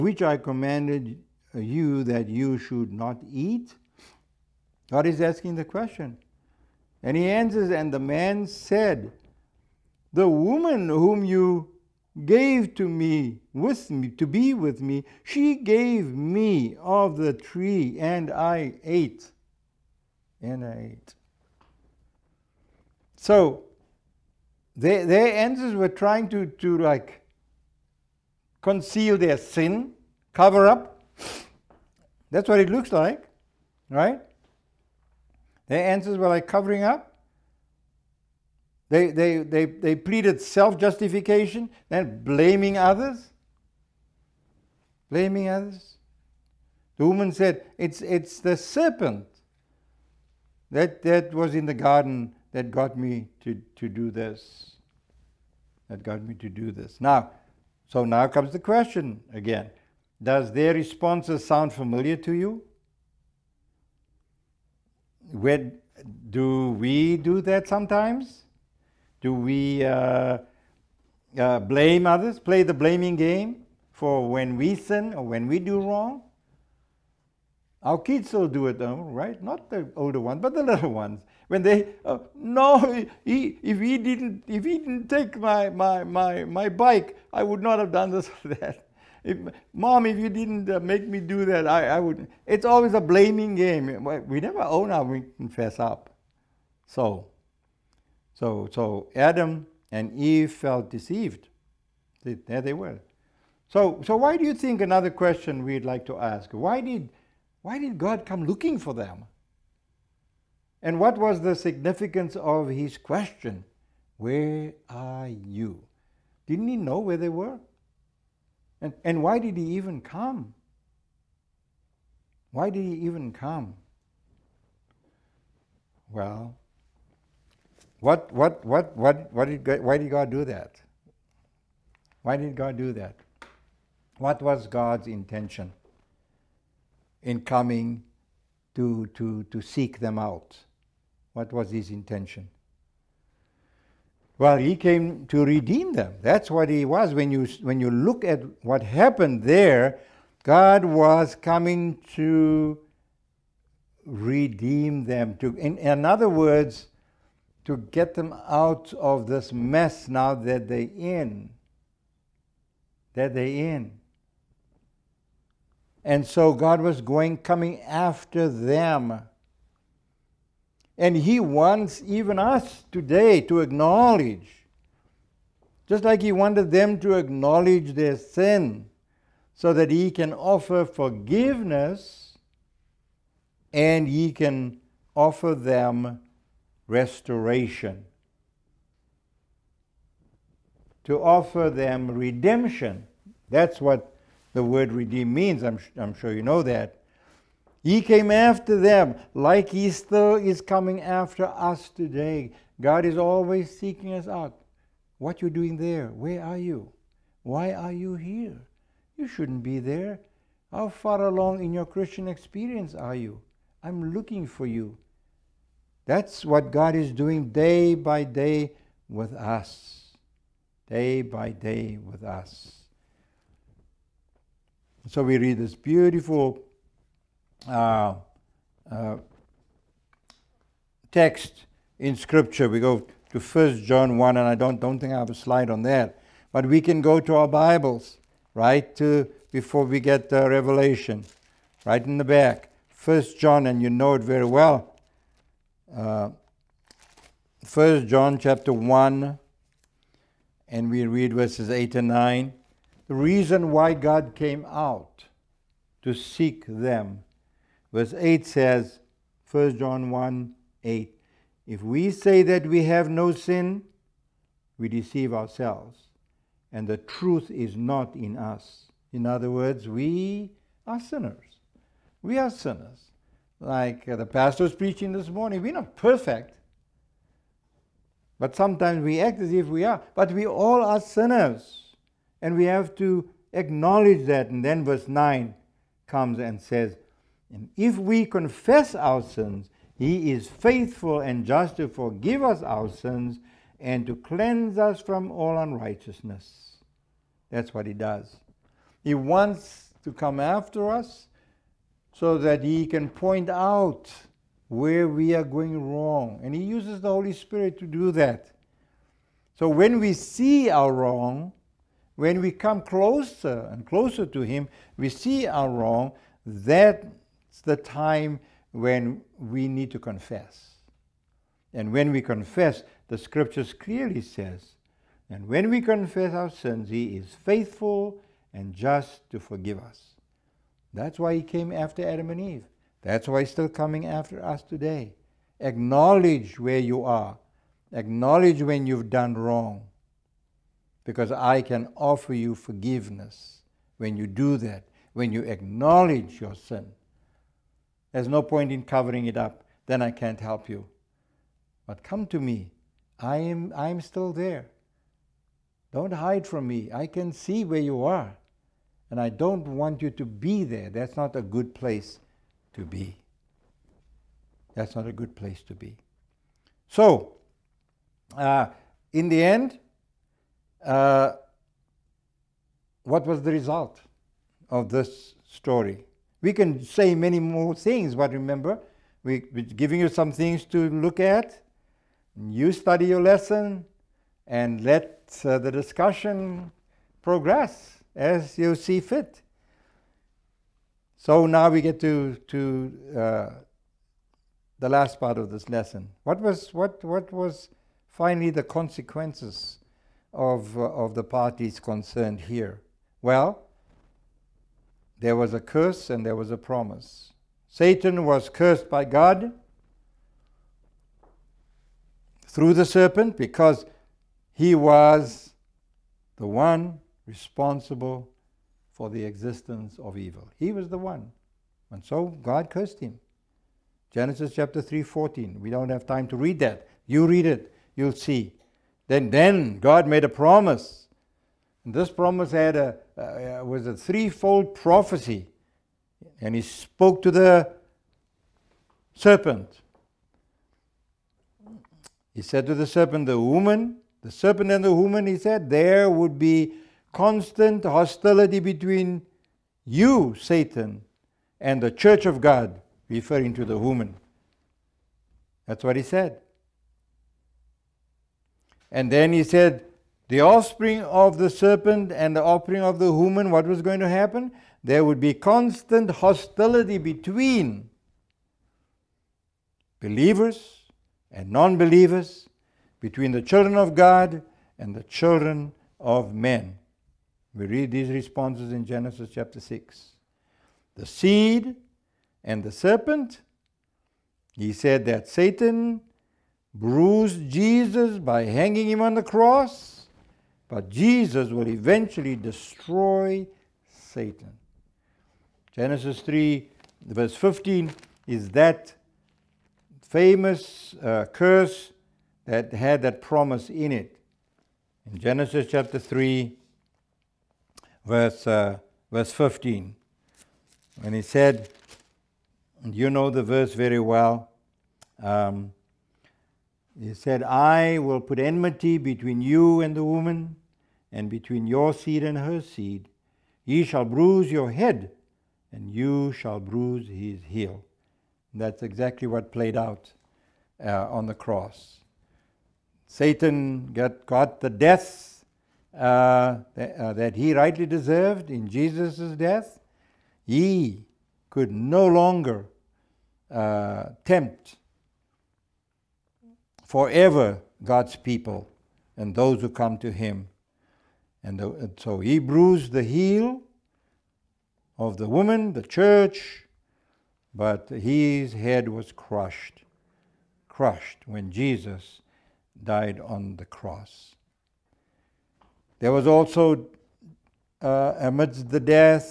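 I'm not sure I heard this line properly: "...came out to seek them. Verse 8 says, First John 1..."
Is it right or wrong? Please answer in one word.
right.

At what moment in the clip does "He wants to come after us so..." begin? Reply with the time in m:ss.
4:59.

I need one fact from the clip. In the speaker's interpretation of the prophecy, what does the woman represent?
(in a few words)
the church of God.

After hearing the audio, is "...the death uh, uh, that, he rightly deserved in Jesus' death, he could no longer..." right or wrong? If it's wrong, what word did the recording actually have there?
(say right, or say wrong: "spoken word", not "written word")
right.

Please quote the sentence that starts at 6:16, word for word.
We can say many more things, but remember, we, we're giving you some things to look at.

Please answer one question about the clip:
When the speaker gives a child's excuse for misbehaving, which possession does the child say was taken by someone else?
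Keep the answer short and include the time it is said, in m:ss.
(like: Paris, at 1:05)
bike, at 1:26.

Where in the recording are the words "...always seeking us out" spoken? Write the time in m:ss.
3:23.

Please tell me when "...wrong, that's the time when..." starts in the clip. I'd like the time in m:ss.
5:15.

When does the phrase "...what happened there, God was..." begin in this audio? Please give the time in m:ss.
2:28.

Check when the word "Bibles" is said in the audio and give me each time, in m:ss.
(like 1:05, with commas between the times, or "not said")
3:57.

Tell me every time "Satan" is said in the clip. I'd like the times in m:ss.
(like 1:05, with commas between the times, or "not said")
6:47, 7:30, 8:05, 8:13, 8:53.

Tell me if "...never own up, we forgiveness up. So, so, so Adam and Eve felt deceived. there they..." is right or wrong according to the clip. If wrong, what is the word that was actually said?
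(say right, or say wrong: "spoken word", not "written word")
wrong: "confess", not "forgiveness".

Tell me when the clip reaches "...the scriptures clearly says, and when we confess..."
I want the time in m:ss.
5:23.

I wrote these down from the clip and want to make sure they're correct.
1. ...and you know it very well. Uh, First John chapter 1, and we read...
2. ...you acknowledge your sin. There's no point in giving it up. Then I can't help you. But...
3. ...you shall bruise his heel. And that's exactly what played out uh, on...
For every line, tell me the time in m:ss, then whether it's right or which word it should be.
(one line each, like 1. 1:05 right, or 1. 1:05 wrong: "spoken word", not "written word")
1. 4:03 right
2. 5:45 wrong: "covering", not "giving"
3. 8:45 right.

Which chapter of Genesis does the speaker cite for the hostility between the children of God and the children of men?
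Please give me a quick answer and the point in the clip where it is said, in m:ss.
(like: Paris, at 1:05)
chapter 6, at 7:58.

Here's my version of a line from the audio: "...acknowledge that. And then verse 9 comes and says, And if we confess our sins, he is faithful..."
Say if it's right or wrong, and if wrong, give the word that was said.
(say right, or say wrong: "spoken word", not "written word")
right.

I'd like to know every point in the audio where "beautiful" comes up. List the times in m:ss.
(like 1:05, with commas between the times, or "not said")
3:45.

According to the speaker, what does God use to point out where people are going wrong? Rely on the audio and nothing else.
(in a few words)
the Holy Spirit.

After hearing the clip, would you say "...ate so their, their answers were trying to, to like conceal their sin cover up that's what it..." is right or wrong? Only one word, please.
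right.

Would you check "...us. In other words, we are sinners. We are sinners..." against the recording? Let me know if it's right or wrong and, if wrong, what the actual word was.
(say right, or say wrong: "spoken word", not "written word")
right.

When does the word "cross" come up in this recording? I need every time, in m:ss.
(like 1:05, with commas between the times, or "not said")
8:09, 8:51, 9:23.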